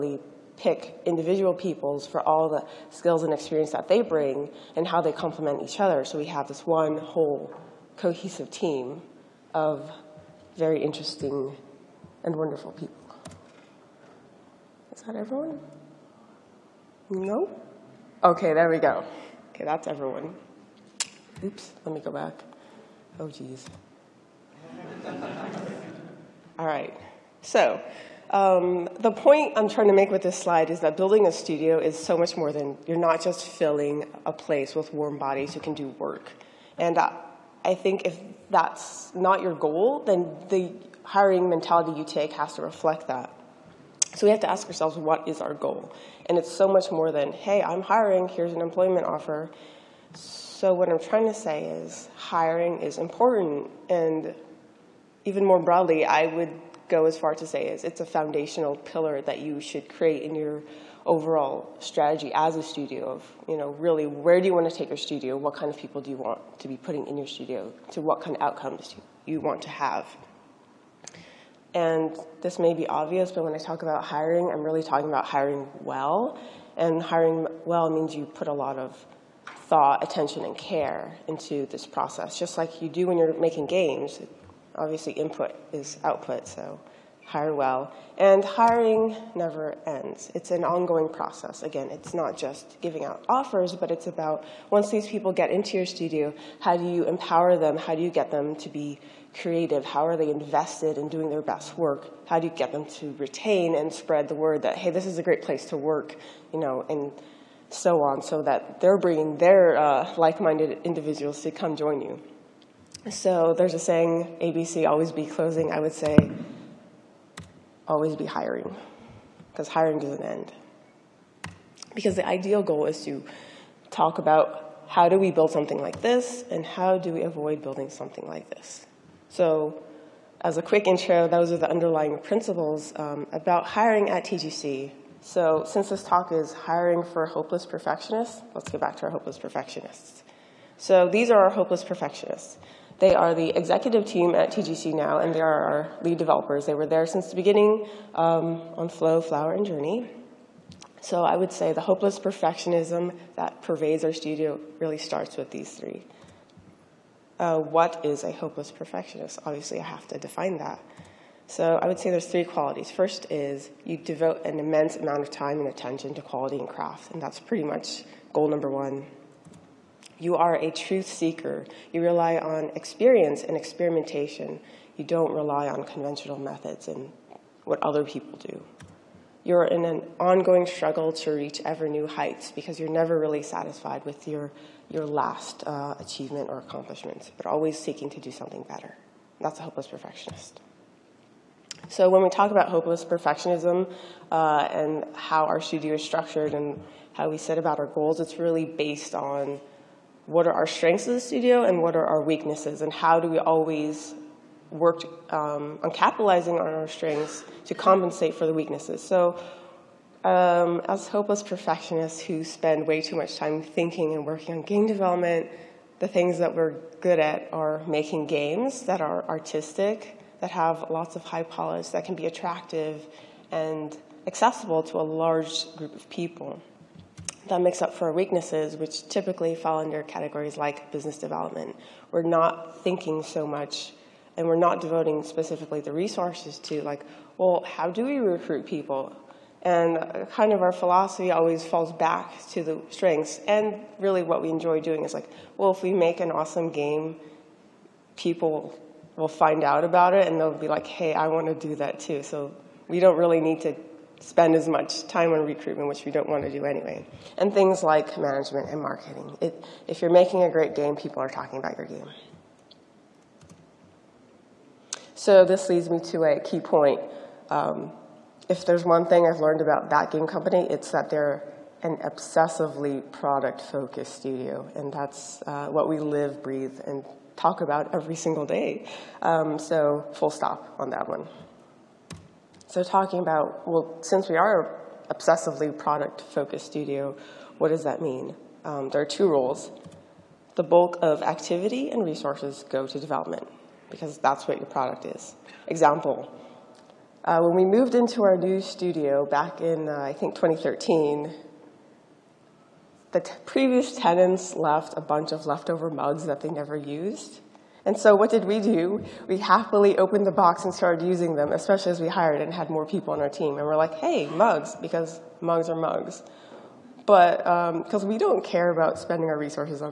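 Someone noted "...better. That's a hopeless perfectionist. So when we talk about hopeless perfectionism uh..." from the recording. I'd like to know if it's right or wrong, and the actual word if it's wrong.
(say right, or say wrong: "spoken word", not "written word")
right.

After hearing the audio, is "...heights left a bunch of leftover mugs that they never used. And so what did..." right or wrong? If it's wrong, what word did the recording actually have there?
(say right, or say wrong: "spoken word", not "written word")
wrong: "tenants", not "heights".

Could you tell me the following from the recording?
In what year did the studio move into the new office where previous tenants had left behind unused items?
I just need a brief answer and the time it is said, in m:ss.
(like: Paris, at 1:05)
2013, at 5:00.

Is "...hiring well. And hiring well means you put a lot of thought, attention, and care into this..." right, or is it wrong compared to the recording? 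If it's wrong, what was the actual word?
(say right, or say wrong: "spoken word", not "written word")
right.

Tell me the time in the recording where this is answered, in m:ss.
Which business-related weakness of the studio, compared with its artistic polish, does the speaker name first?
3:50.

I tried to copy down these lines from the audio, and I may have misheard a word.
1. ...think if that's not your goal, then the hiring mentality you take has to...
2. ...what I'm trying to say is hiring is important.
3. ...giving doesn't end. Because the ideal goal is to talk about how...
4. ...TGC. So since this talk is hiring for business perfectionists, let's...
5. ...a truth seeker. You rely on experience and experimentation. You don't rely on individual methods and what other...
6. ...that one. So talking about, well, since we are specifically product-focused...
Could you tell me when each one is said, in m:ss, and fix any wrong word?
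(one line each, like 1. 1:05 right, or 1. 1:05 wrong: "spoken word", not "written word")
1. 0:37 right
2. 0:50 right
3. 1:59 wrong: "hiring", not "giving"
4. 2:14 wrong: "hopeless", not "business"
5. 2:50 wrong: "conventional", not "individual"
6. 4:40 wrong: "obsessively", not "specifically".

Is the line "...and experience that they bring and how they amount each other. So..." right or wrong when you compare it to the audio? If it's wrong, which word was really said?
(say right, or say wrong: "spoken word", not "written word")
wrong: "complement", not "amount".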